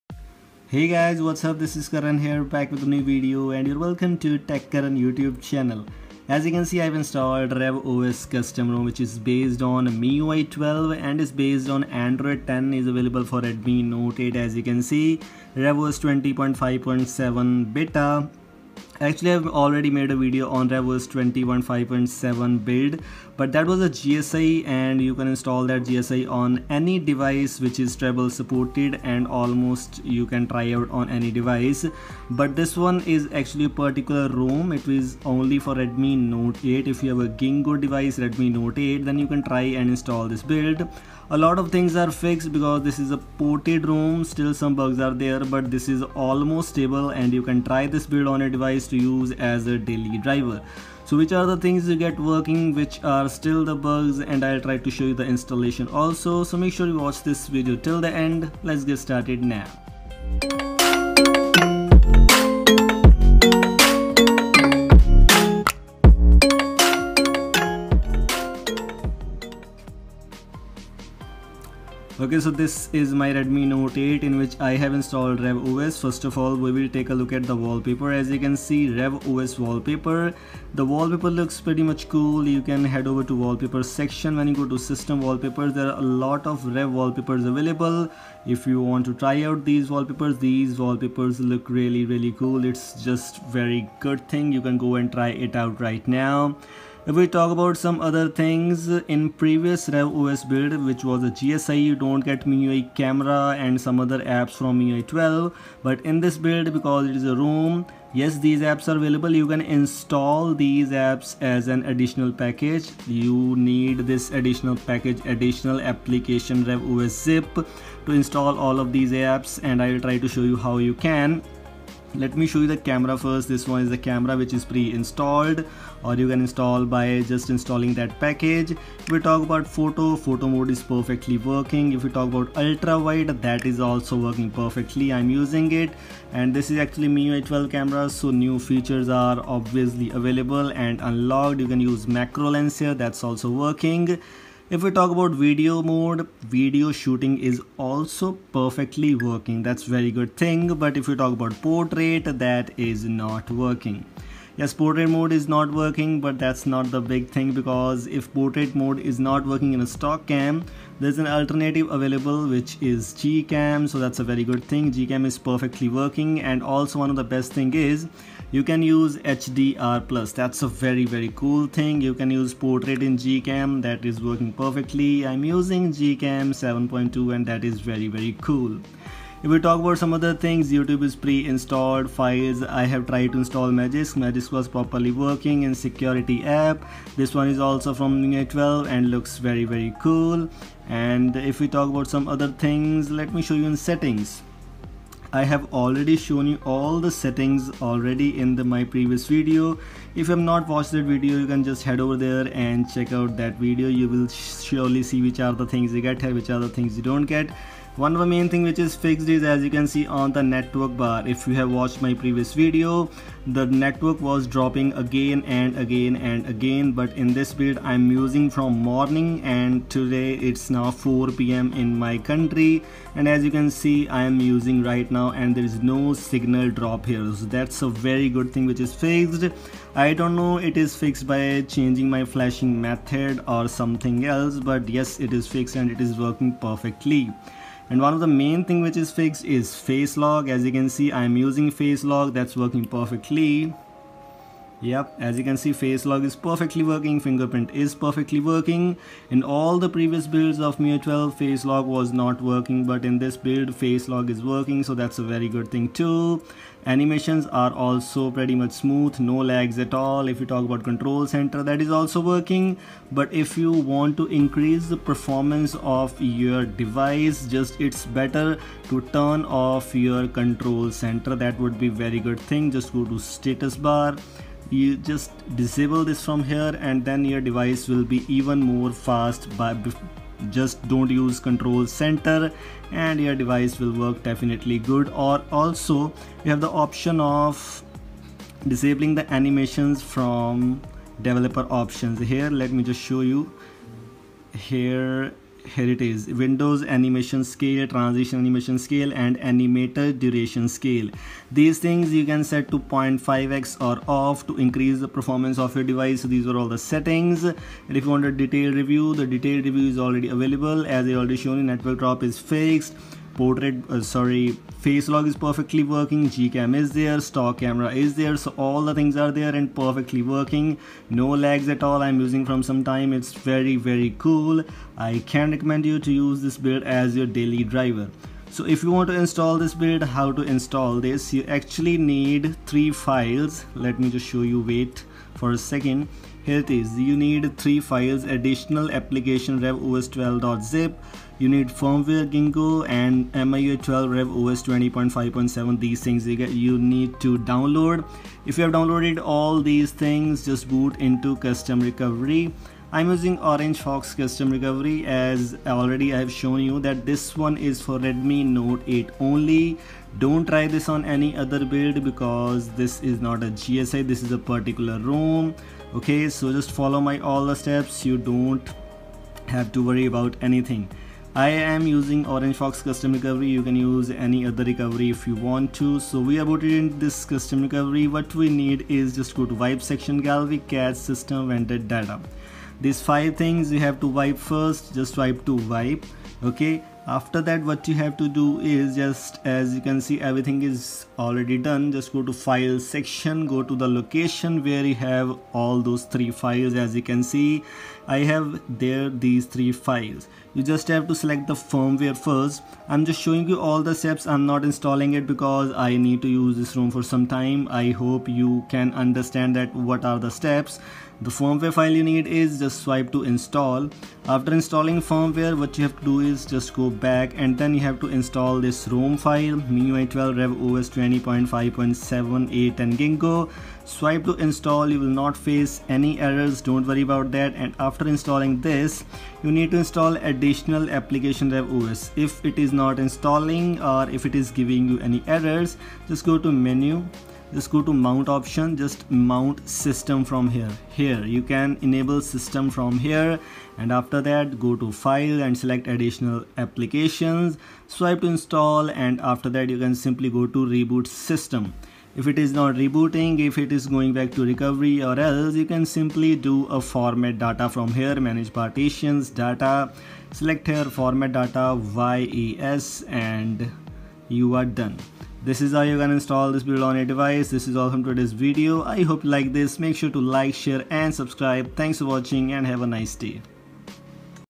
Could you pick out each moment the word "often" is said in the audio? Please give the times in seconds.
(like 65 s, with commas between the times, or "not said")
not said.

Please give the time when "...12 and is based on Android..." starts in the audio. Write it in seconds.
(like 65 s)
10 s.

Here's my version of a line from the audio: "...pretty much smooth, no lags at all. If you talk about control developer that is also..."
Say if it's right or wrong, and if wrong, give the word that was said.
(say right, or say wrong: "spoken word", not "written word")
wrong: "center", not "developer".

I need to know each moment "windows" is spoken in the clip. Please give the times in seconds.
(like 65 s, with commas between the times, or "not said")
296 s.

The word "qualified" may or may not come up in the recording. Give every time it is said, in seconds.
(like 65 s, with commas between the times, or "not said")
not said.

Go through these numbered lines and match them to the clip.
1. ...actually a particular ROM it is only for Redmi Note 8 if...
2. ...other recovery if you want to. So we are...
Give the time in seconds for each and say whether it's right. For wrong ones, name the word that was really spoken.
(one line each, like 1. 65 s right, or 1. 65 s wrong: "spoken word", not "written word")
1. 33 s right
2. 374 s right.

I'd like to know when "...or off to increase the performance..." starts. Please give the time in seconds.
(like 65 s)
303 s.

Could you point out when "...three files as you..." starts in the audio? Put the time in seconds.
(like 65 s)
396 s.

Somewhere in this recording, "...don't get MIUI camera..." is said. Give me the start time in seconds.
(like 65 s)
101 s.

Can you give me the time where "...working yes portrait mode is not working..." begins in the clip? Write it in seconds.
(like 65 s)
153 s.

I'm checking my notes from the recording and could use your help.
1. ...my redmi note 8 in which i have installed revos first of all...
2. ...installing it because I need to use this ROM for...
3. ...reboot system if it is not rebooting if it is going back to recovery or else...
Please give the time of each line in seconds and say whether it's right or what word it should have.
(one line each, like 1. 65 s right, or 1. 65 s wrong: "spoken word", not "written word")
1. 73 s right
2. 404 s right
3. 450 s right.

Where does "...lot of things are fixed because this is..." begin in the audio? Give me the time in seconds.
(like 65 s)
41 s.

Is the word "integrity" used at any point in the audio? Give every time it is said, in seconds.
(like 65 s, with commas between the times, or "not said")
not said.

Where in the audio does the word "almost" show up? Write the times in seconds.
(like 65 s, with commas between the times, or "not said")
29 s, 46 s.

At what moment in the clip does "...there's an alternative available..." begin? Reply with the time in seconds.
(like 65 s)
161 s.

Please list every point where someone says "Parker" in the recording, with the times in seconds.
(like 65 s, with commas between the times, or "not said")
not said.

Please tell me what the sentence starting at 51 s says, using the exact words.
So which are the things you get working which are still the bugs and I'll try to show you the installation also.